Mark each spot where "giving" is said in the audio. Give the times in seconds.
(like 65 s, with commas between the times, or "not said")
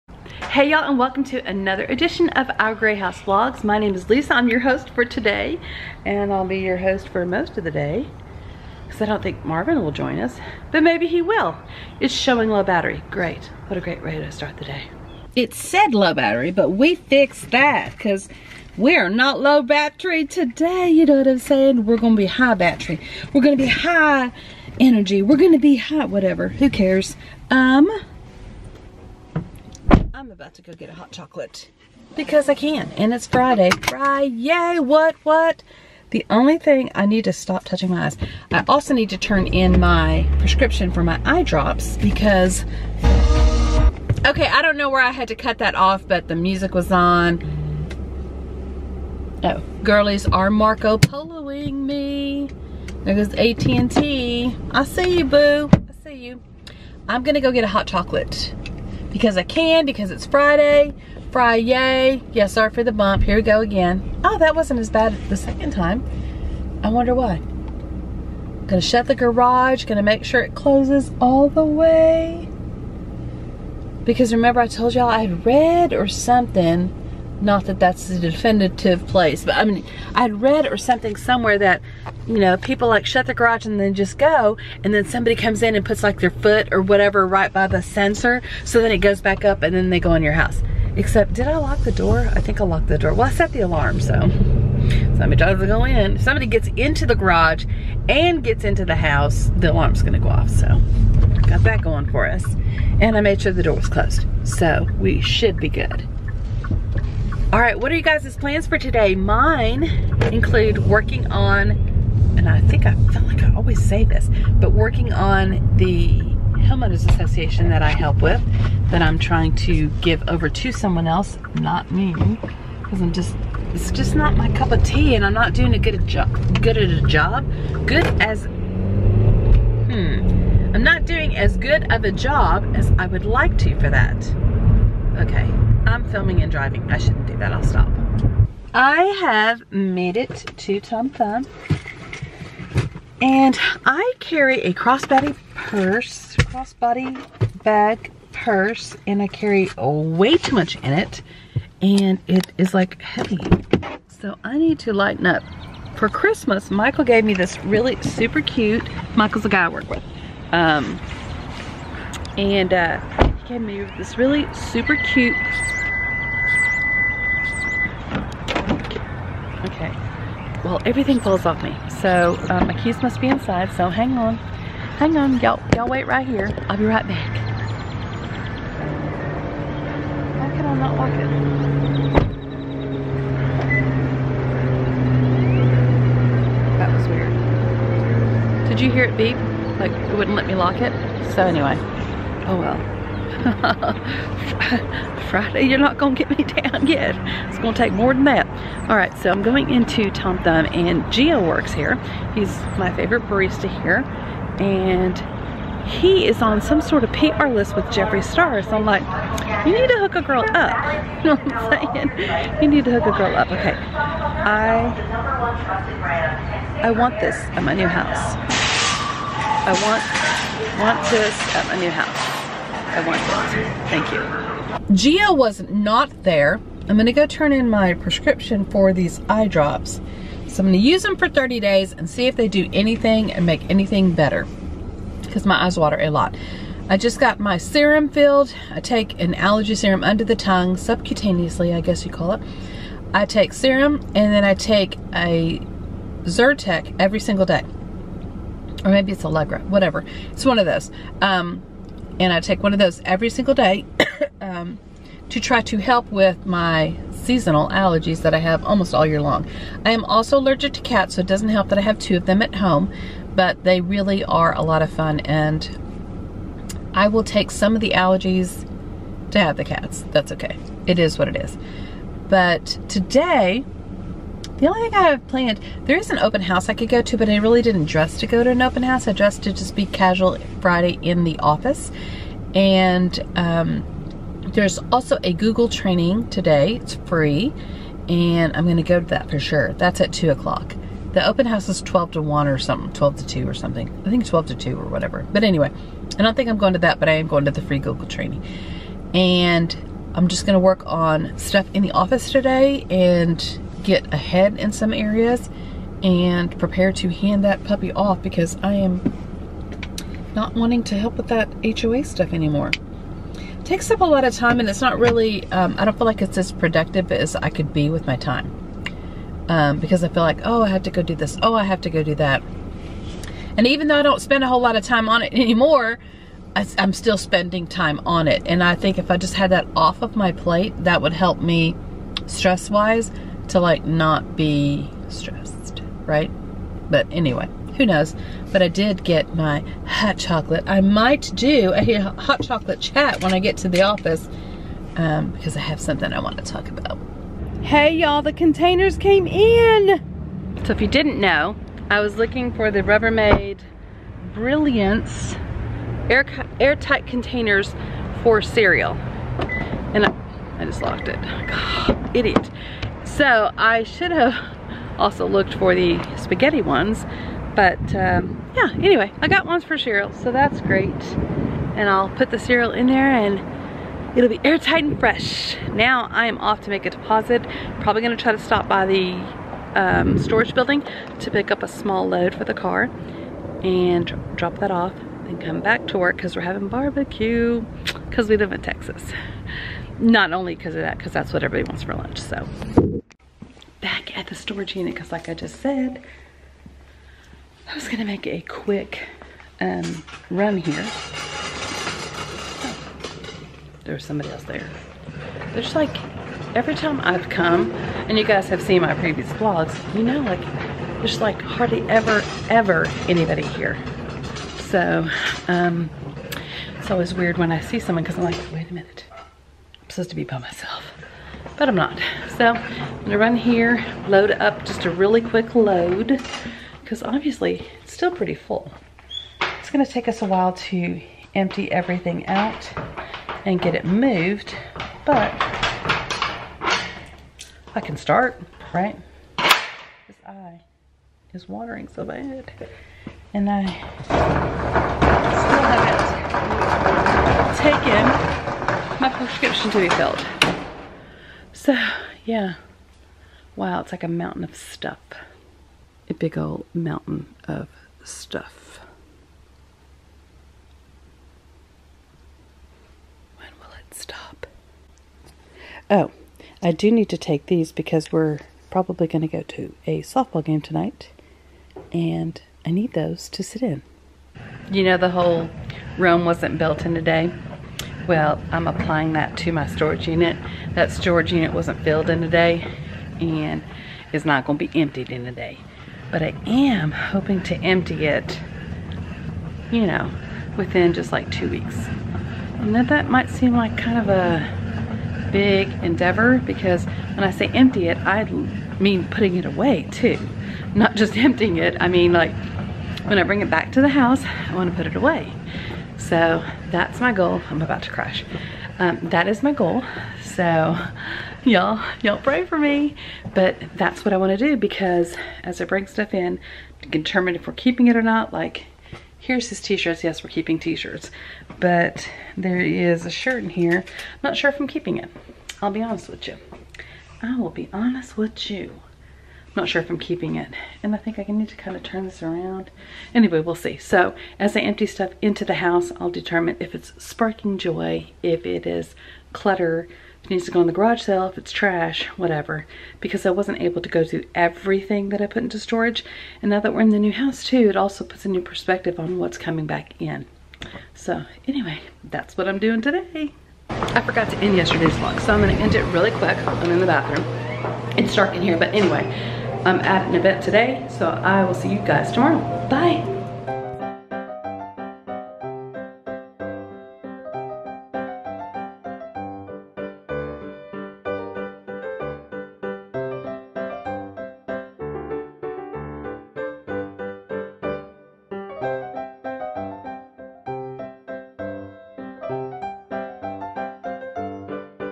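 not said.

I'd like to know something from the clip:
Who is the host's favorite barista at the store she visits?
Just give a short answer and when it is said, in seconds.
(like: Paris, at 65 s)
Gio, at 201 s.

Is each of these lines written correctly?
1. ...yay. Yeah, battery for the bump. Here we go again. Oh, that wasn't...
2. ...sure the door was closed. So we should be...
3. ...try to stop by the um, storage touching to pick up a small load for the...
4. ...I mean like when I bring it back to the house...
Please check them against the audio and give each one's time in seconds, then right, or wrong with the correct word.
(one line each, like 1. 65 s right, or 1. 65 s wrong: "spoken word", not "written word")
1. 61 s wrong: "sorry", not "battery"
2. 103 s right
3. 378 s wrong: "building", not "touching"
4. 501 s right.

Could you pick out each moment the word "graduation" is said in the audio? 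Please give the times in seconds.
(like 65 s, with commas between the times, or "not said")
not said.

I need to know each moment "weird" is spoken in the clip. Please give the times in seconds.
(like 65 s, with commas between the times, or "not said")
187 s, 417 s.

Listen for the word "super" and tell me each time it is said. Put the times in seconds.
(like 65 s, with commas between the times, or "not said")
158 s, 164 s.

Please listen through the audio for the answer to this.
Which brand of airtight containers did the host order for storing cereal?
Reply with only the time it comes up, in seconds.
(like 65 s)
352 s.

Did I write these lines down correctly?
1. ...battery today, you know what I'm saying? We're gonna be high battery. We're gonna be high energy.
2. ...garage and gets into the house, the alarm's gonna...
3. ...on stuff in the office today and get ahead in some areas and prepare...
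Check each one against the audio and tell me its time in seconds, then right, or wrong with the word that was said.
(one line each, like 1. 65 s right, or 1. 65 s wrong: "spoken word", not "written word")
1. 19 s right
2. 97 s right
3. 300 s right.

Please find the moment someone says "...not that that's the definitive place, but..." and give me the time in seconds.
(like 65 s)
77 s.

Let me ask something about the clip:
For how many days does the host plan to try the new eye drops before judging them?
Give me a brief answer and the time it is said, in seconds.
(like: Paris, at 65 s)
30, at 231 s.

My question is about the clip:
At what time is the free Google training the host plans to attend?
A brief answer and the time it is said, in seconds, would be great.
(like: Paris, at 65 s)
2 o'clock, at 290 s.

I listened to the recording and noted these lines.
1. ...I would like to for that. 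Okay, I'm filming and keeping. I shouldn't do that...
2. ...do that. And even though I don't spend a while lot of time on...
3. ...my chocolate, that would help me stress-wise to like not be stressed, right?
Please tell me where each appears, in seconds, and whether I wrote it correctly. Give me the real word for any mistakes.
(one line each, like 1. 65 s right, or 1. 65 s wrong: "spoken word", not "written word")
1. 132 s wrong: "driving", not "keeping"
2. 322 s wrong: "whole", not "while"
3. 330 s wrong: "plate", not "chocolate".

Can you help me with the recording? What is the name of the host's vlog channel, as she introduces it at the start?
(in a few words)
Our Gray House Vlogs.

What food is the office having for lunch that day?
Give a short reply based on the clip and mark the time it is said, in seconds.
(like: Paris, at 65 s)
barbecue, at 386 s.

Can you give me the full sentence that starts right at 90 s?
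Except, did I lock the door?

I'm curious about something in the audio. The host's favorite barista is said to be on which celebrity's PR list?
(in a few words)
Jeffree Star.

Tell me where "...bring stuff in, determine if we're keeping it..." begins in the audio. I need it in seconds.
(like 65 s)
515 s.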